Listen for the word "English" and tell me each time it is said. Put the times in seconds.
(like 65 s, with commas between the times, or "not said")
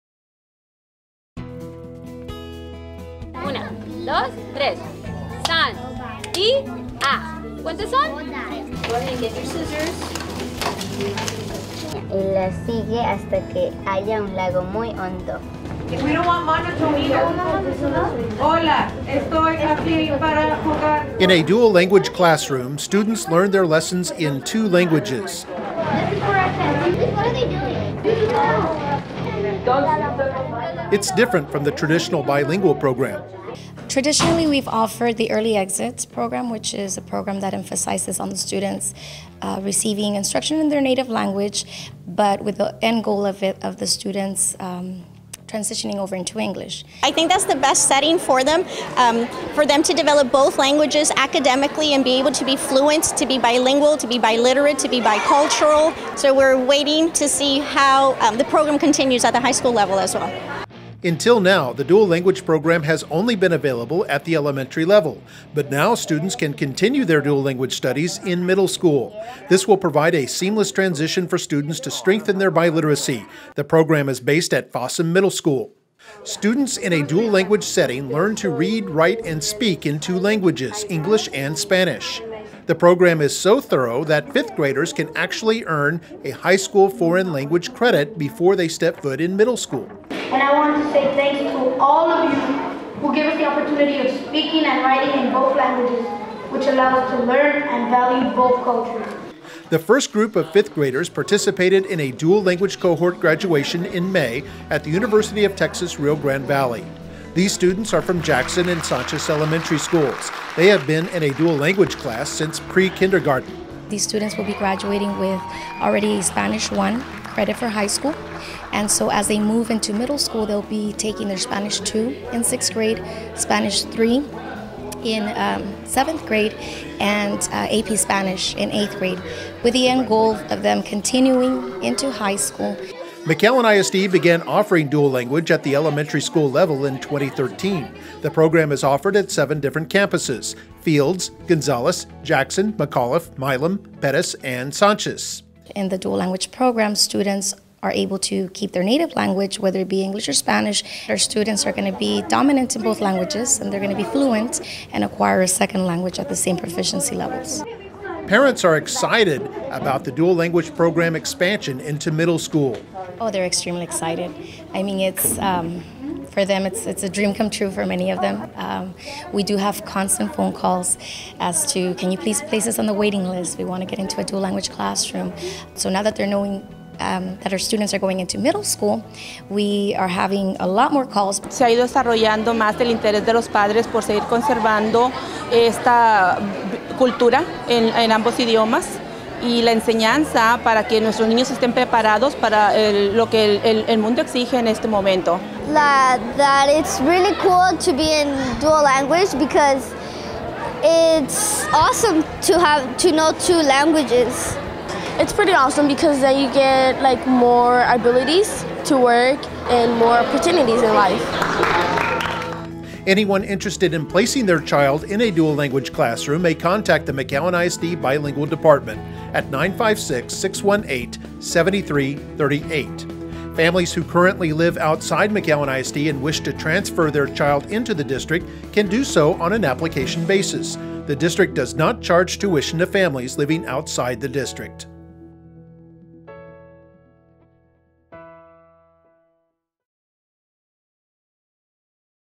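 46 s, 80 s, 150 s.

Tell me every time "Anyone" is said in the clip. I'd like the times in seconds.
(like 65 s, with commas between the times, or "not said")
213 s.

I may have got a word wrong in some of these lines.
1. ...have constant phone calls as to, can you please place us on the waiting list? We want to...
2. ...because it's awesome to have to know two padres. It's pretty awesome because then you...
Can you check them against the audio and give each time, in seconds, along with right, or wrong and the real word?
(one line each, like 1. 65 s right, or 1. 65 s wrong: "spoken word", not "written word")
1. 169 s right
2. 199 s wrong: "languages", not "padres".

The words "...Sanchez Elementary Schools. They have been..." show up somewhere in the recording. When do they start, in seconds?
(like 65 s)
108 s.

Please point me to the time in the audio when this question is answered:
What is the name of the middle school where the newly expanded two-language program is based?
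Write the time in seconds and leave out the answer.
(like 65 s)
74 s.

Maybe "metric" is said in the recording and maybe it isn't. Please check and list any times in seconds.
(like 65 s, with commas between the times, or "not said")
not said.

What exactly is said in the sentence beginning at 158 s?
Parents are excited about the dual language program expansion into middle school.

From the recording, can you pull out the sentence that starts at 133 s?
McAllen ISD began offering dual language at the elementary school level in 2013.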